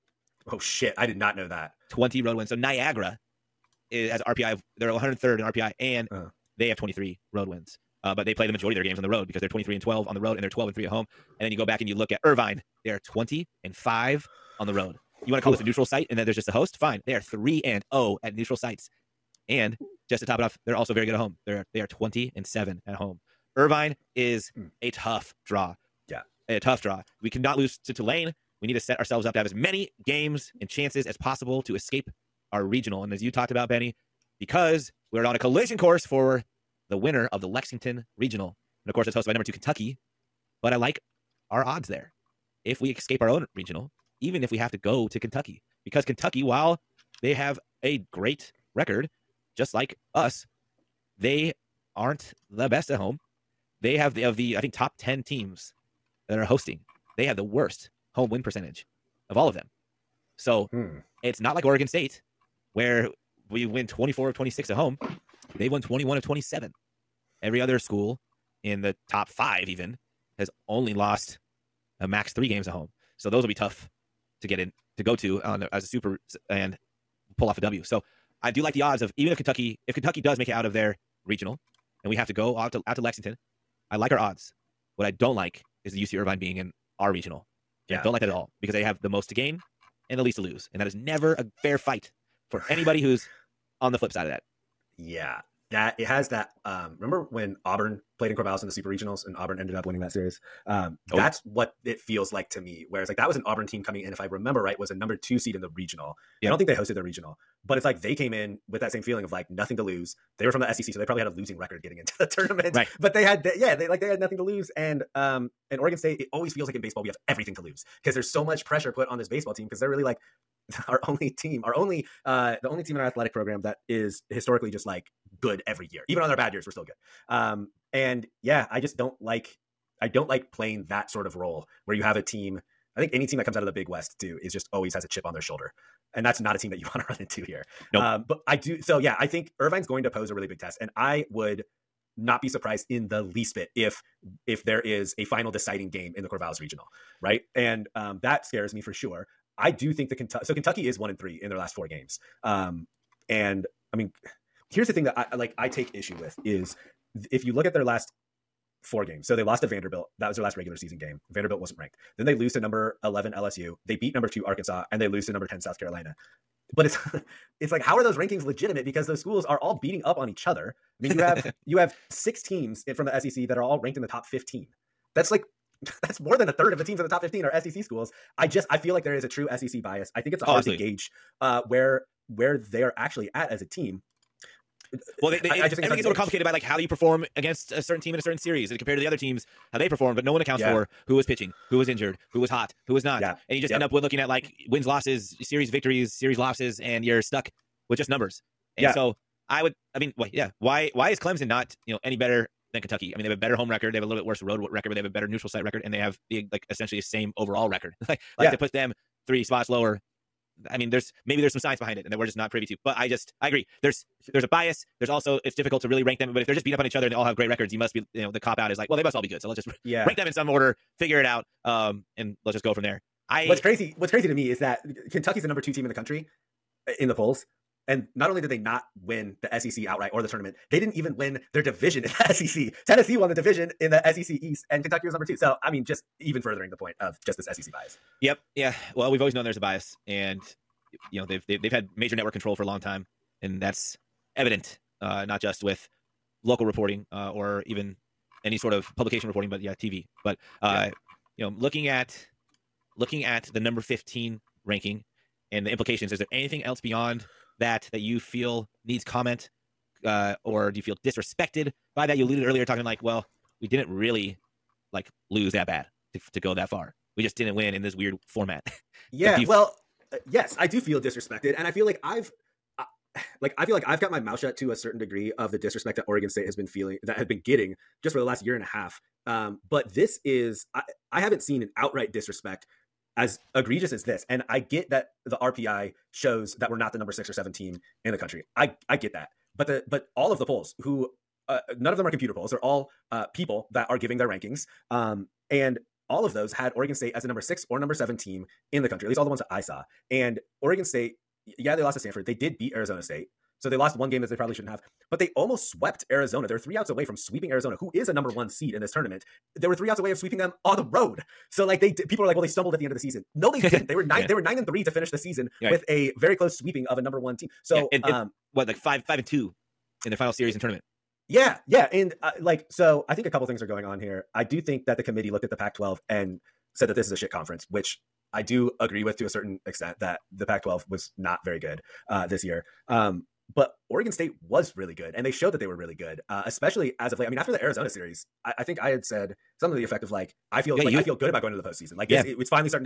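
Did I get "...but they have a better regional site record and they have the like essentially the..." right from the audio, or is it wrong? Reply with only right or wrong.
wrong.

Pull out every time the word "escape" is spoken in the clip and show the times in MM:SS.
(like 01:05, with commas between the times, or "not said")
00:31, 00:42.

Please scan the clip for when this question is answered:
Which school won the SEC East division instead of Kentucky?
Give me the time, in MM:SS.
03:52.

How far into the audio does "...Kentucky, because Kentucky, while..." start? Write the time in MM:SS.
00:45.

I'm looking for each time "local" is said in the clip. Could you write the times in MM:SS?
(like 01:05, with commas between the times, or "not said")
04:06.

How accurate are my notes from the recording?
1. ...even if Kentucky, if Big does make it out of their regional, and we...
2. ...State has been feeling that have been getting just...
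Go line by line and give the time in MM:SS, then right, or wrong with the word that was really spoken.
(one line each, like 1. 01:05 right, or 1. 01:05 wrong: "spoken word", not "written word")
1. 01:19 wrong: "Kentucky", not "Big"
2. 04:36 right.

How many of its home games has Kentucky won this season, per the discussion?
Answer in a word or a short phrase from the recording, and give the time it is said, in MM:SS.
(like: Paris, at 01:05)
21 of 27, at 01:05.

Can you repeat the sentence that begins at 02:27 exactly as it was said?
And um, that scares me for sure.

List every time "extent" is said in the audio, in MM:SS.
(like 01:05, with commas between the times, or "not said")
05:29.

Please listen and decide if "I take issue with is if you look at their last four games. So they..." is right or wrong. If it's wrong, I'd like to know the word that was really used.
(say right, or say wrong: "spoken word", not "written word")
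right.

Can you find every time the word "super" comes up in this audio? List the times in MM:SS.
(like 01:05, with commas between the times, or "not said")
01:15, 01:38.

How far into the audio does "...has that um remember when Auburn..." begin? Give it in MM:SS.
01:36.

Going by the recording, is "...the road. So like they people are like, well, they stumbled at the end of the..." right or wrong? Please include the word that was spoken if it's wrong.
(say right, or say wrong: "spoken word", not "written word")
right.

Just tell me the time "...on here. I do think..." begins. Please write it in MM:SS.
05:23.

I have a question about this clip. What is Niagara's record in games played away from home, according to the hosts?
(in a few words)
23-12.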